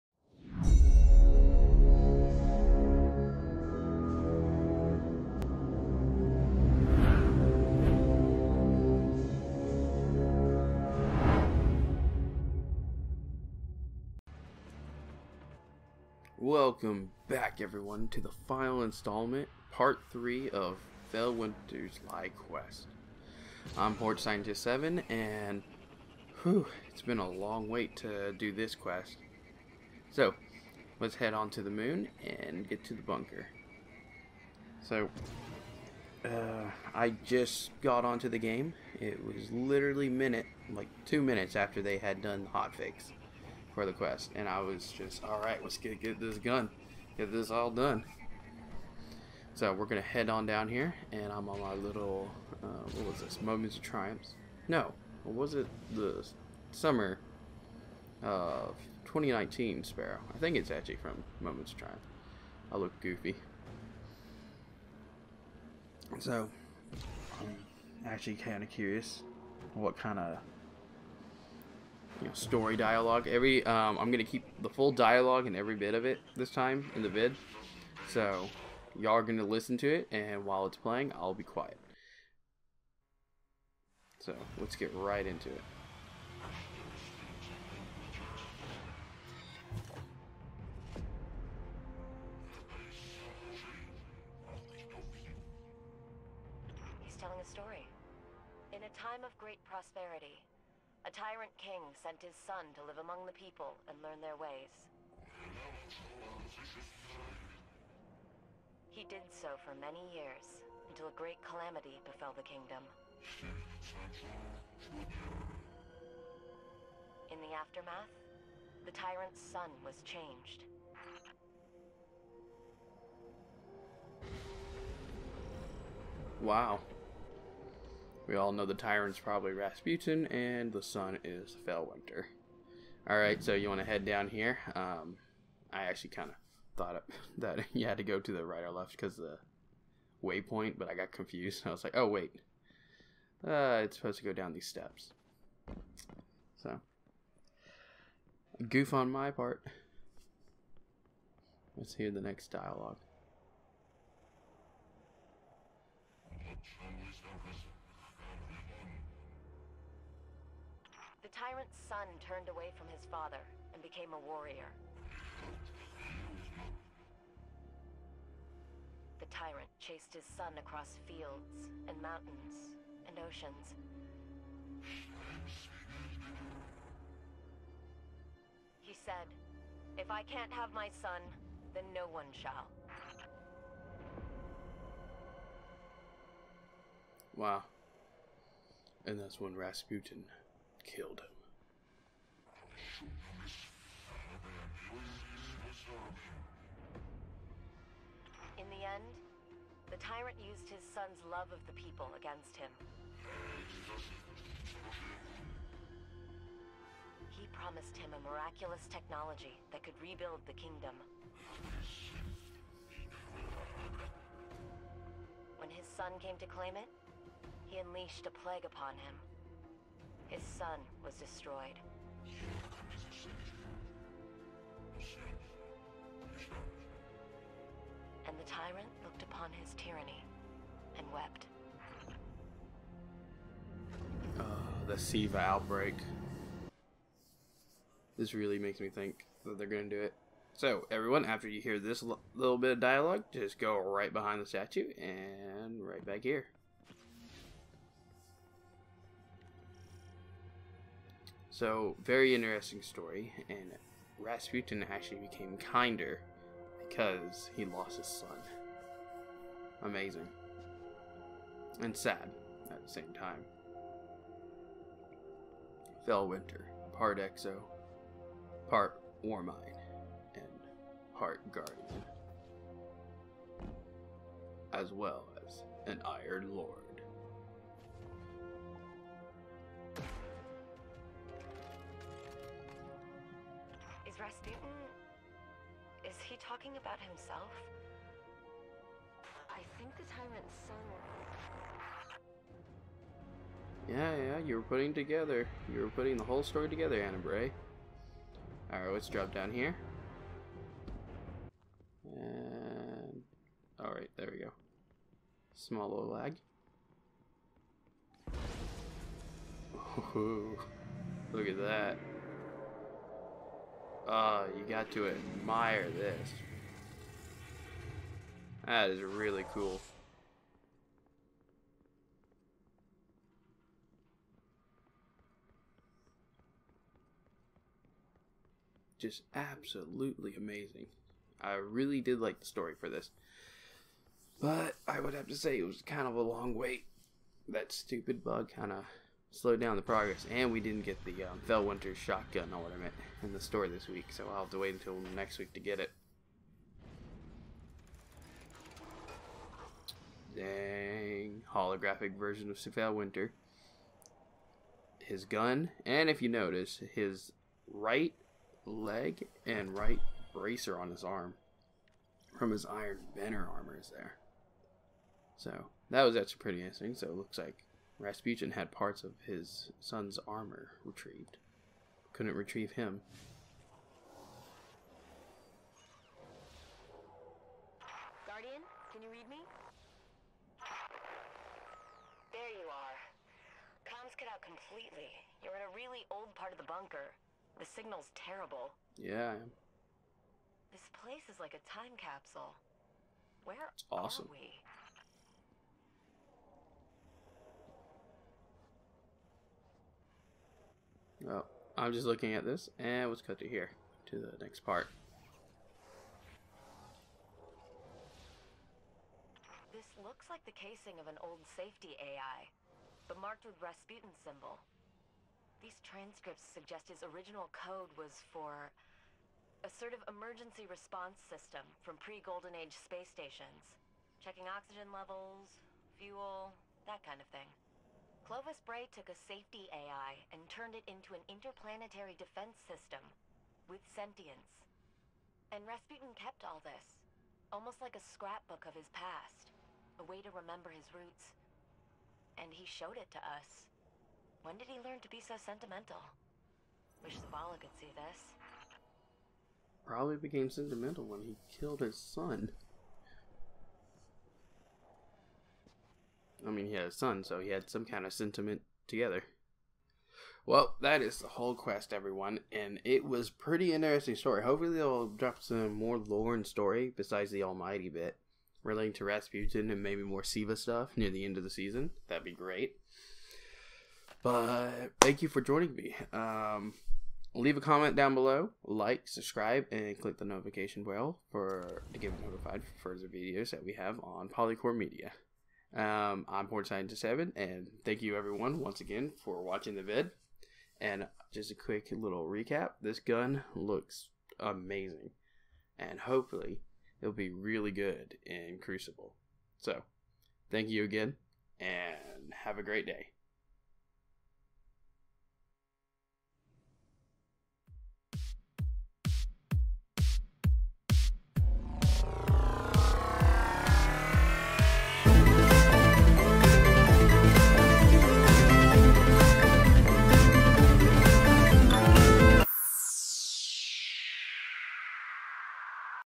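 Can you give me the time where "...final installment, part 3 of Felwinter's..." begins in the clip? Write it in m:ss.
0:18.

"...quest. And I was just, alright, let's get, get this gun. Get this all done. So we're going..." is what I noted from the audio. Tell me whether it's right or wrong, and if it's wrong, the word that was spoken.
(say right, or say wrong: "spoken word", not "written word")
right.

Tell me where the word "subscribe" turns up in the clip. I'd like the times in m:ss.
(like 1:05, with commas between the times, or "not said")
7:59.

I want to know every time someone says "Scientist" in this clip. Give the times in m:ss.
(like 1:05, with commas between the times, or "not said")
0:24, 8:06.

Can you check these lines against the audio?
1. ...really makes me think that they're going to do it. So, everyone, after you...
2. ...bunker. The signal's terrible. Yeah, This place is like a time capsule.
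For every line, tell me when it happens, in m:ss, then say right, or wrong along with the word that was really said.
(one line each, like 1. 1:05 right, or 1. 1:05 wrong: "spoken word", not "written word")
1. 3:58 right
2. 6:26 right.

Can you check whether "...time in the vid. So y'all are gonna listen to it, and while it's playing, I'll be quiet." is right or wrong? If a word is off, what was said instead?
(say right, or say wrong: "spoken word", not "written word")
right.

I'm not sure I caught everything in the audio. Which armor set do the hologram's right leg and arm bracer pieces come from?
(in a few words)
Iron Banner armor.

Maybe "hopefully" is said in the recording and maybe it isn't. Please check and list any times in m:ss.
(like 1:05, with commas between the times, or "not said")
7:44, 8:15.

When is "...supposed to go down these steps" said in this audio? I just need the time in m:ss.
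2:23.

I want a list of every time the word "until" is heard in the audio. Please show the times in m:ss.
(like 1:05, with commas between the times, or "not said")
1:50, 5:44.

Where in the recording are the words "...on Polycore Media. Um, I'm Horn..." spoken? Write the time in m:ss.
8:04.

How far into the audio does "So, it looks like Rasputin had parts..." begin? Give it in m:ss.
6:06.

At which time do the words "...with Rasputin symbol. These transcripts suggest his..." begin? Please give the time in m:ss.
6:53.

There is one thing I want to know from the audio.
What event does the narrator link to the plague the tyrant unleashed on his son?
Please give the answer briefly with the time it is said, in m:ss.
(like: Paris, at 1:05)
The Siva outbreak, at 3:54.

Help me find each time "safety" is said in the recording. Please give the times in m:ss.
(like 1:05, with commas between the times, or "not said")
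6:51, 7:09.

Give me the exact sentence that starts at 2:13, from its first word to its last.
Alright, so you want to head down here.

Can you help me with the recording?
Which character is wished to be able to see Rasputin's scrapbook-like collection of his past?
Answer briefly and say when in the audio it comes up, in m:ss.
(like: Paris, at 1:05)
Zavala, at 7:27.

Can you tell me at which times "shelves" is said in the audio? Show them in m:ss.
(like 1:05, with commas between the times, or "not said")
not said.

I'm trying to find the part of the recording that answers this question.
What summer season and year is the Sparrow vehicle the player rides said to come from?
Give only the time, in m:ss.
0:56.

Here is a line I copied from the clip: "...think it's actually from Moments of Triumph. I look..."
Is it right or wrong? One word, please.
right.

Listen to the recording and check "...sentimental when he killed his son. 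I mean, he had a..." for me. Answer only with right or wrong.
right.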